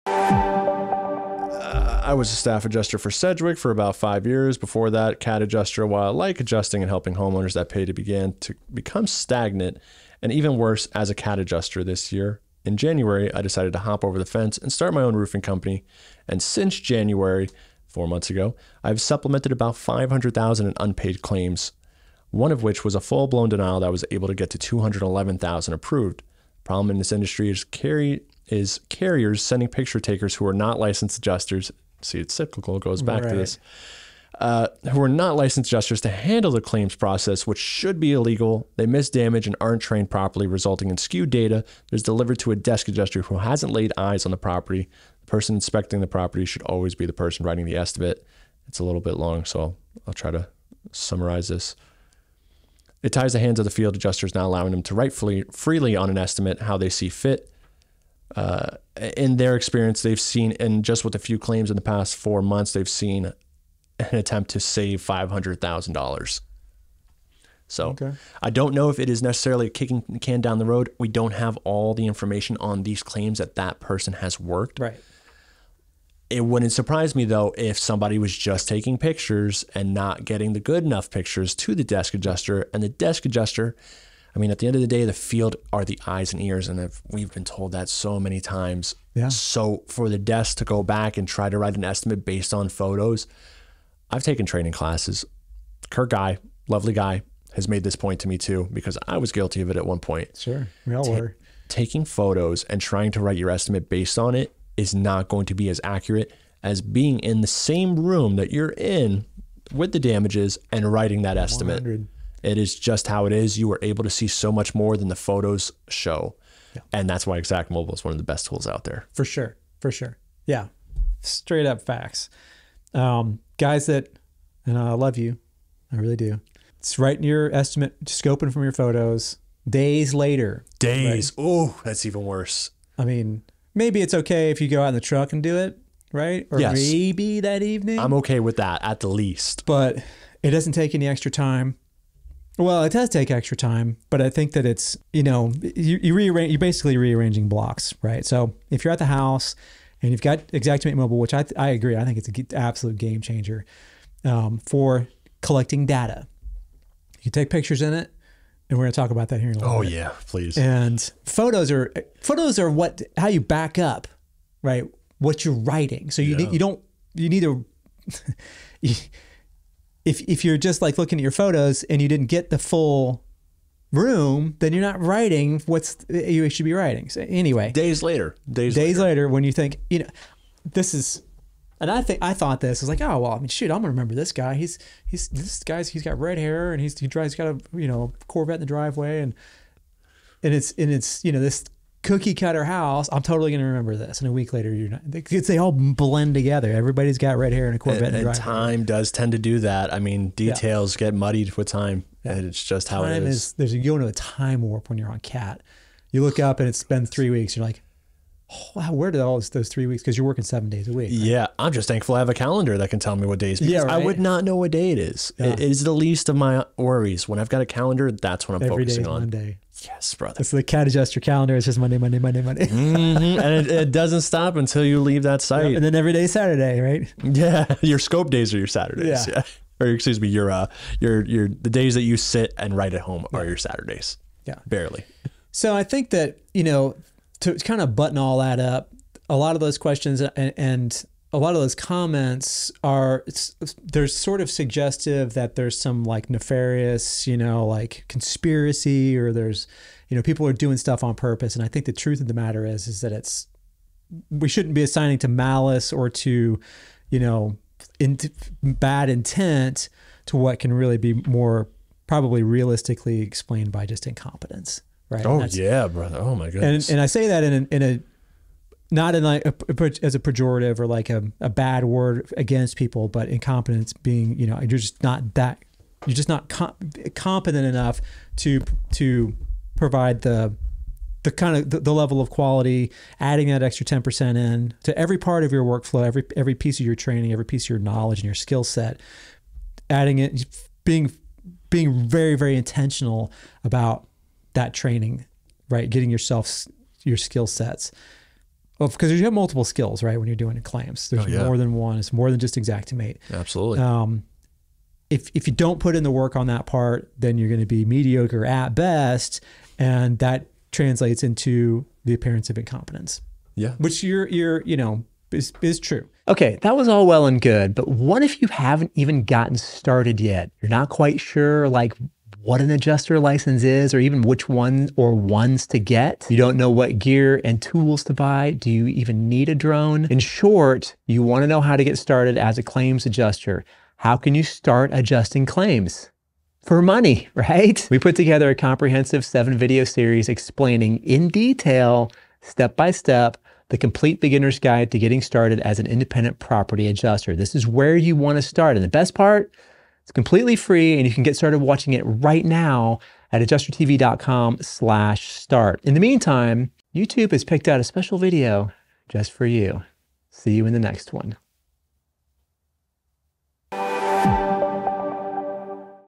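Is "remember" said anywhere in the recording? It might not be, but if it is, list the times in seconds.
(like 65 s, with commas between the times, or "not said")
183 s, 193 s.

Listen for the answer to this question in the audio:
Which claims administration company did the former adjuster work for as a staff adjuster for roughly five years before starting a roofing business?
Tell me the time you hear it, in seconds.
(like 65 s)
3 s.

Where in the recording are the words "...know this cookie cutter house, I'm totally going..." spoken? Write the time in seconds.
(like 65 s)
191 s.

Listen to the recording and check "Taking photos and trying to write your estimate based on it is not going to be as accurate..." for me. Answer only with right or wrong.
right.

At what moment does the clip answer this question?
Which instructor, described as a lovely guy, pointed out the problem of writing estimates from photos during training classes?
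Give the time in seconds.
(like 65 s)
95 s.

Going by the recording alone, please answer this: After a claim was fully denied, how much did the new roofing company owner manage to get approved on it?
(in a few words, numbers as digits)
211,000.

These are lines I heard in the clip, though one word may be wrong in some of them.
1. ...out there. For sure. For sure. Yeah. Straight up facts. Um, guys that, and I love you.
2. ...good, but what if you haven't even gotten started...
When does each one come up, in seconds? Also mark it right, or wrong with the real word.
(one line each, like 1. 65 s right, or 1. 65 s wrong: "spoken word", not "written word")
1. 118 s right
2. 317 s right.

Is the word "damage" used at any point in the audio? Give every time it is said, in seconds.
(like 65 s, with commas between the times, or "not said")
39 s, 109 s.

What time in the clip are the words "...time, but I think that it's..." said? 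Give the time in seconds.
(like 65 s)
143 s.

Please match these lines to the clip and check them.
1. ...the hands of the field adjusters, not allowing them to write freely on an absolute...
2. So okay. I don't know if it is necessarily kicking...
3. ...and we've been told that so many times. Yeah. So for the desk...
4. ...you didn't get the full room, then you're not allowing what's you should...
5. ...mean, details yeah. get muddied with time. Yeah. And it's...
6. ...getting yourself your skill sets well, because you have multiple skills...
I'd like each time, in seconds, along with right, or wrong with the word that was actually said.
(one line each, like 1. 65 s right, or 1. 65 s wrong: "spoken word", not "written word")
1. 53 s wrong: "estimate", not "absolute"
2. 67 s right
3. 86 s right
4. 172 s wrong: "writing", not "allowing"
5. 199 s right
6. 295 s right.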